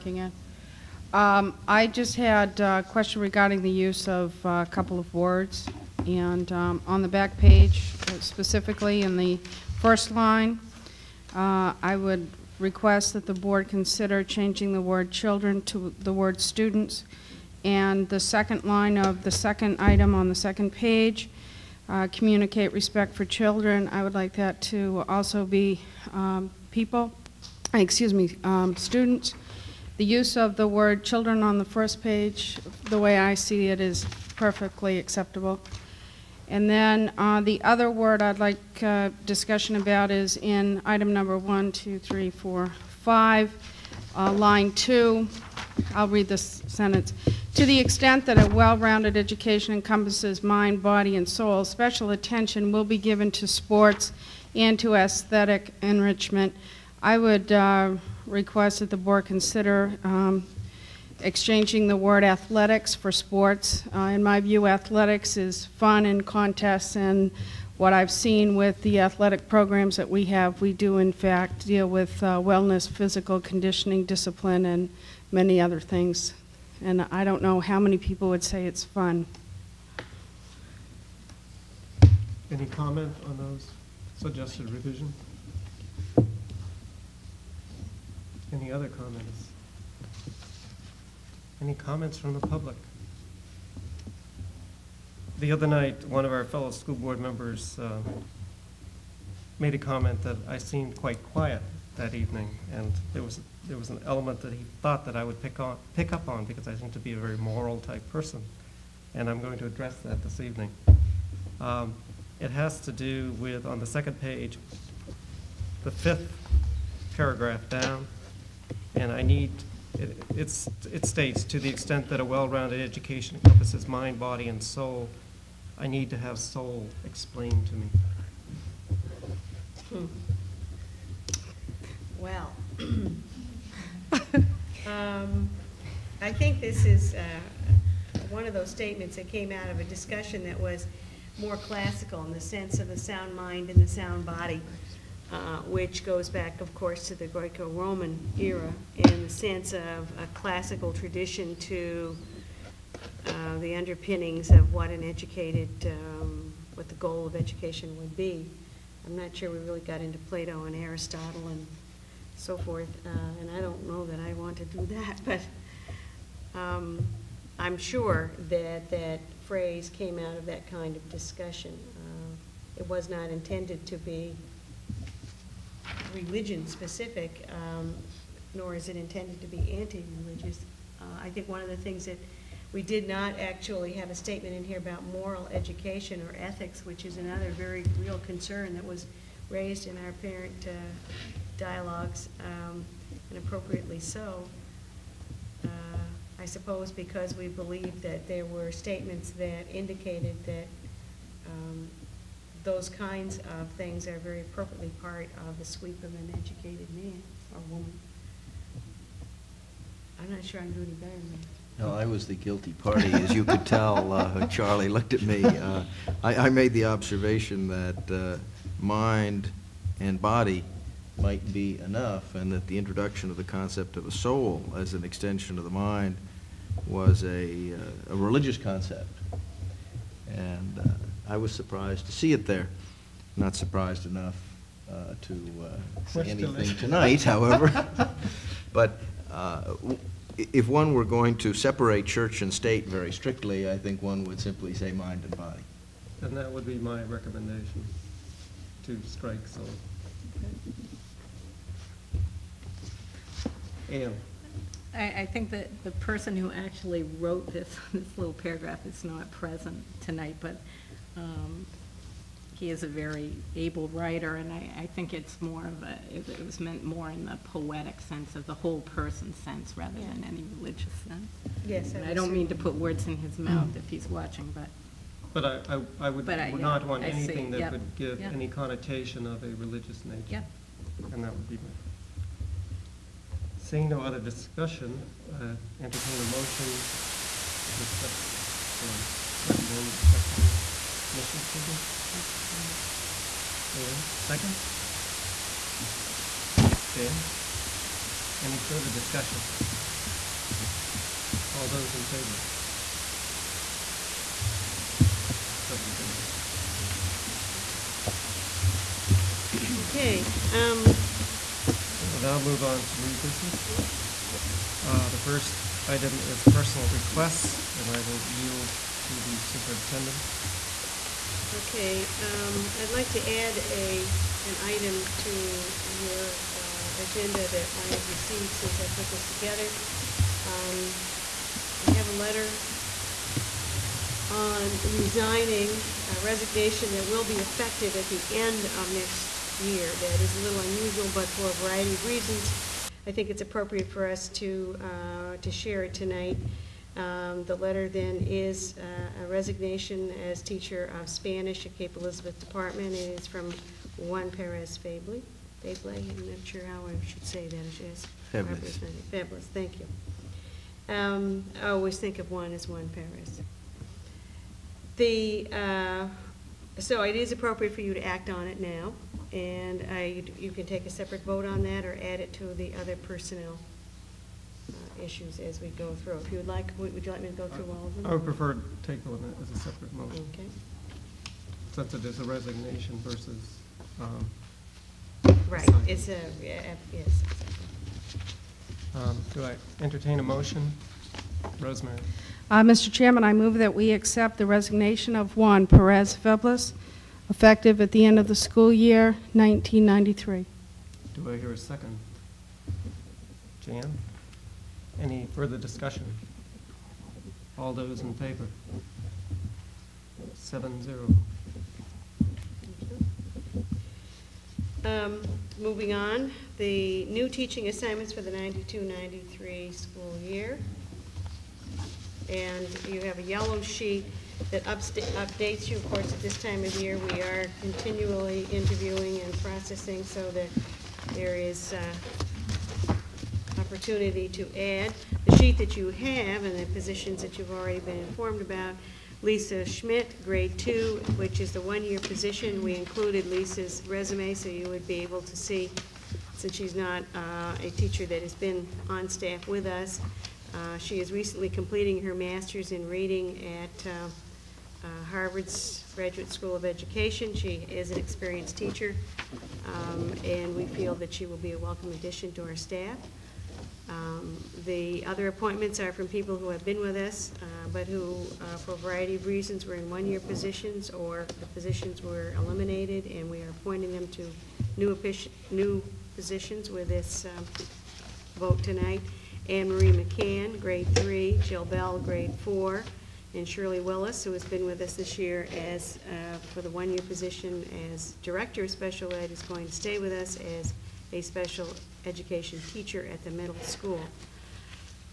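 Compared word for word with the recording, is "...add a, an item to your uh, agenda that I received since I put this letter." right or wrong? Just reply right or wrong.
wrong.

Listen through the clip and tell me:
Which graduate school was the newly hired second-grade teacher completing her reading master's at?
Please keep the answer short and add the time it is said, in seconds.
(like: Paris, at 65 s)
Harvard's Graduate School of Education, at 455 s.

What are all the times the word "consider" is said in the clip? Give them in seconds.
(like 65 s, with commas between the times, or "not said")
13 s, 59 s.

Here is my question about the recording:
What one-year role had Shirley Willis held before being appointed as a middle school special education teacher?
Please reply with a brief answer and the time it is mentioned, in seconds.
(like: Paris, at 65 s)
Director of Special Ed, at 488 s.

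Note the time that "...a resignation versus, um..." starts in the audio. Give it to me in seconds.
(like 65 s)
382 s.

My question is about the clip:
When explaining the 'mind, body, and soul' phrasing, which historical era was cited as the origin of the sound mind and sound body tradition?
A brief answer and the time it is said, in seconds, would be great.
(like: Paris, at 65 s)
Greco-Roman era, at 147 s.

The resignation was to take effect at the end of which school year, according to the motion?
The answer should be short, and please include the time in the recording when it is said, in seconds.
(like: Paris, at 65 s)
1993, at 399 s.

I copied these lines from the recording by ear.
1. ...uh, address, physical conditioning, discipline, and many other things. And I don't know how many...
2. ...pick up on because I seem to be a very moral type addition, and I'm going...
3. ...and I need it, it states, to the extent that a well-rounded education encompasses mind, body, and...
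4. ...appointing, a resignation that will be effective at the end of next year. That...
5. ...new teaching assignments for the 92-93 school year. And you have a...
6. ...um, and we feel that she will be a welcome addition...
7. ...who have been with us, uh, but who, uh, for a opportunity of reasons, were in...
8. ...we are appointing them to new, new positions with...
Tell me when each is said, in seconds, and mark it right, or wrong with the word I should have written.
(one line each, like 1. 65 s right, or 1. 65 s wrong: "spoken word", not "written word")
1. 72 s wrong: "wellness", not "address"
2. 105 s wrong: "person", not "addition"
3. 118 s right
4. 334 s wrong: "resigning", not "appointing"
5. 417 s right
6. 459 s right
7. 466 s wrong: "variety", not "opportunity"
8. 473 s right.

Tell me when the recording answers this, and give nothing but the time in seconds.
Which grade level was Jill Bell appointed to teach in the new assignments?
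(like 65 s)
481 s.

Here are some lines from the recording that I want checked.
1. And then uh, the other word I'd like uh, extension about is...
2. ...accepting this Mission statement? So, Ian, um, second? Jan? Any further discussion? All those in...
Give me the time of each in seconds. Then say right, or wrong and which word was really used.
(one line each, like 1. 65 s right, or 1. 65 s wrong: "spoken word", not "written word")
1. 36 s wrong: "discussion", not "extension"
2. 290 s right.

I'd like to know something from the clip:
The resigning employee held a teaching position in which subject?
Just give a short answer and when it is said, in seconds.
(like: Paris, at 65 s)
Spanish, at 351 s.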